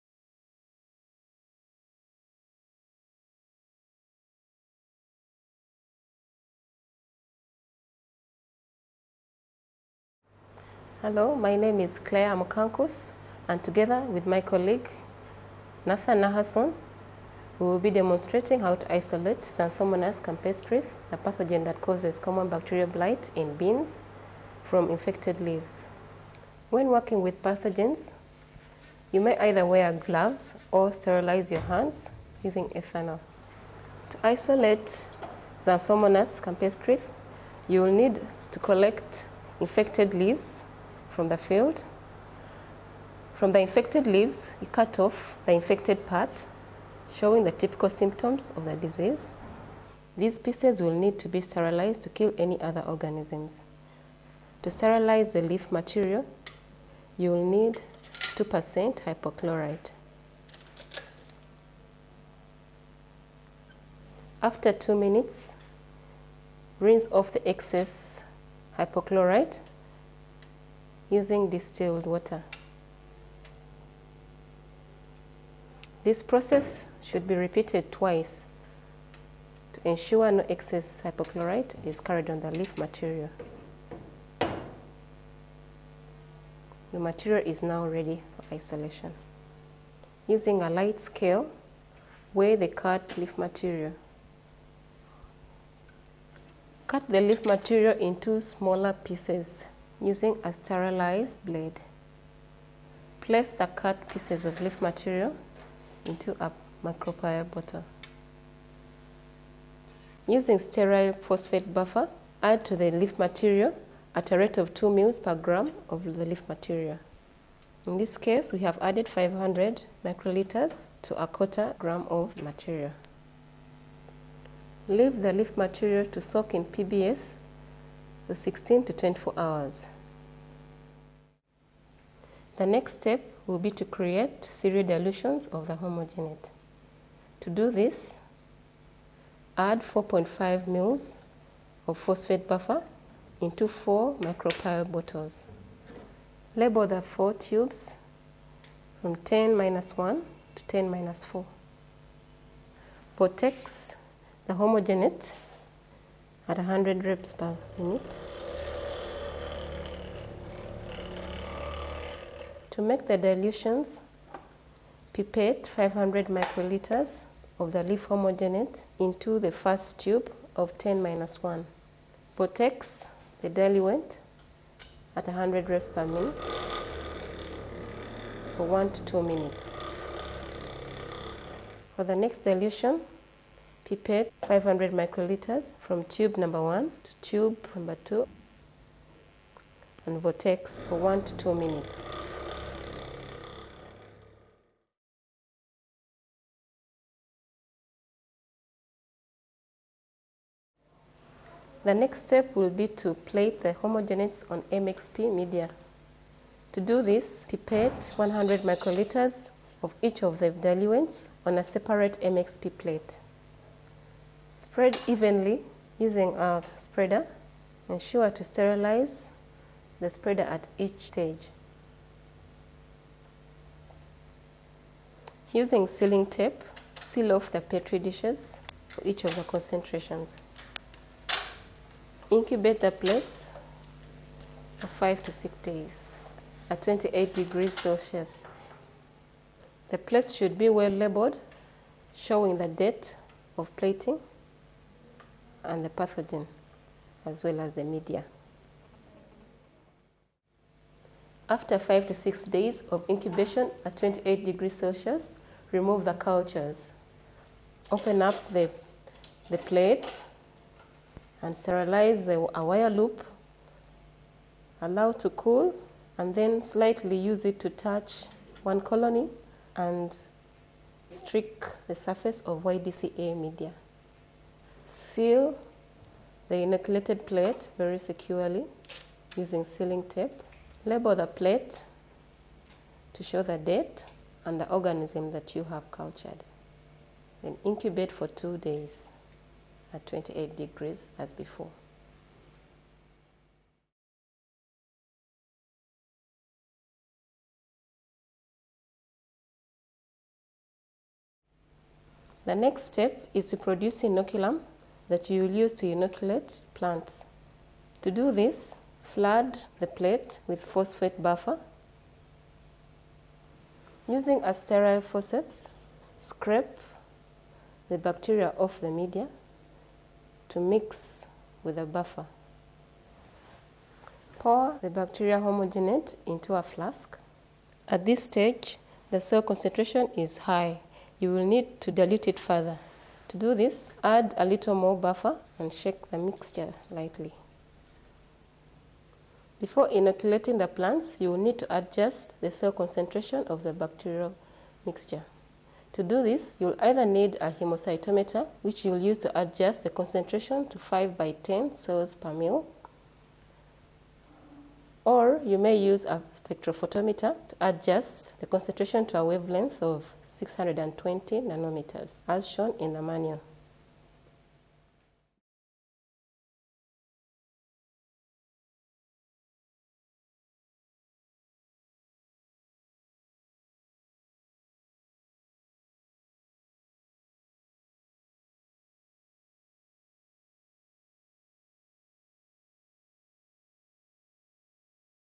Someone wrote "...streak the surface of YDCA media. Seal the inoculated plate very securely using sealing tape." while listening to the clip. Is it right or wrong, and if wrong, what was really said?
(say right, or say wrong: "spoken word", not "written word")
right.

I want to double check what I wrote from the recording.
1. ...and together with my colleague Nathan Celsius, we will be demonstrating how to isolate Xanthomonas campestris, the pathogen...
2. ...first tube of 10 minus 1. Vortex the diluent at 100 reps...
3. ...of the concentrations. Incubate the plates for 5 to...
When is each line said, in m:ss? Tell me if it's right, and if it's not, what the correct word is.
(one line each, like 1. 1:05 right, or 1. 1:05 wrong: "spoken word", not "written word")
1. 0:13 wrong: "Nahason", not "Celsius"
2. 2:49 right
3. 3:49 right.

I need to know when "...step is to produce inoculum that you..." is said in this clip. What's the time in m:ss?
5:02.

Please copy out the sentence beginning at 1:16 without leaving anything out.
This process should be repeated twice to ensure no excess hypochlorite is carried on the leaf material.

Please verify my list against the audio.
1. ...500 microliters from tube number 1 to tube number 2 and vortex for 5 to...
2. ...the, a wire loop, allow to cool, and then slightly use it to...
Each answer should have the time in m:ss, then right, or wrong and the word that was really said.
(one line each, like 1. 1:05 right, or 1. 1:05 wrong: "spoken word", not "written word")
1. 3:04 wrong: "1", not "5"
2. 4:22 right.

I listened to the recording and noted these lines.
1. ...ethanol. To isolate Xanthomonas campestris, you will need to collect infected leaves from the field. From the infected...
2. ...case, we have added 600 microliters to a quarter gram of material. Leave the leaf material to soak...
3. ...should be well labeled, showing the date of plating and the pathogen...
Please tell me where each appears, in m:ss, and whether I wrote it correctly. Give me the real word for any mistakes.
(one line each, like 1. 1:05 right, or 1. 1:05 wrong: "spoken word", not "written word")
1. 0:32 right
2. 1:58 wrong: "500", not "600"
3. 4:00 right.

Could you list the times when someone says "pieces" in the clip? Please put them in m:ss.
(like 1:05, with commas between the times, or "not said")
0:50, 1:38, 1:44.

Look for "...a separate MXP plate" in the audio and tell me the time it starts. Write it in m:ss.
3:31.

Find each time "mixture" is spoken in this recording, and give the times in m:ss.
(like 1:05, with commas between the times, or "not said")
5:36, 5:44.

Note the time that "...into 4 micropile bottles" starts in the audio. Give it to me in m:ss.
2:23.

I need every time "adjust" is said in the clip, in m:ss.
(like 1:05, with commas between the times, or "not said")
5:41, 5:49, 5:57.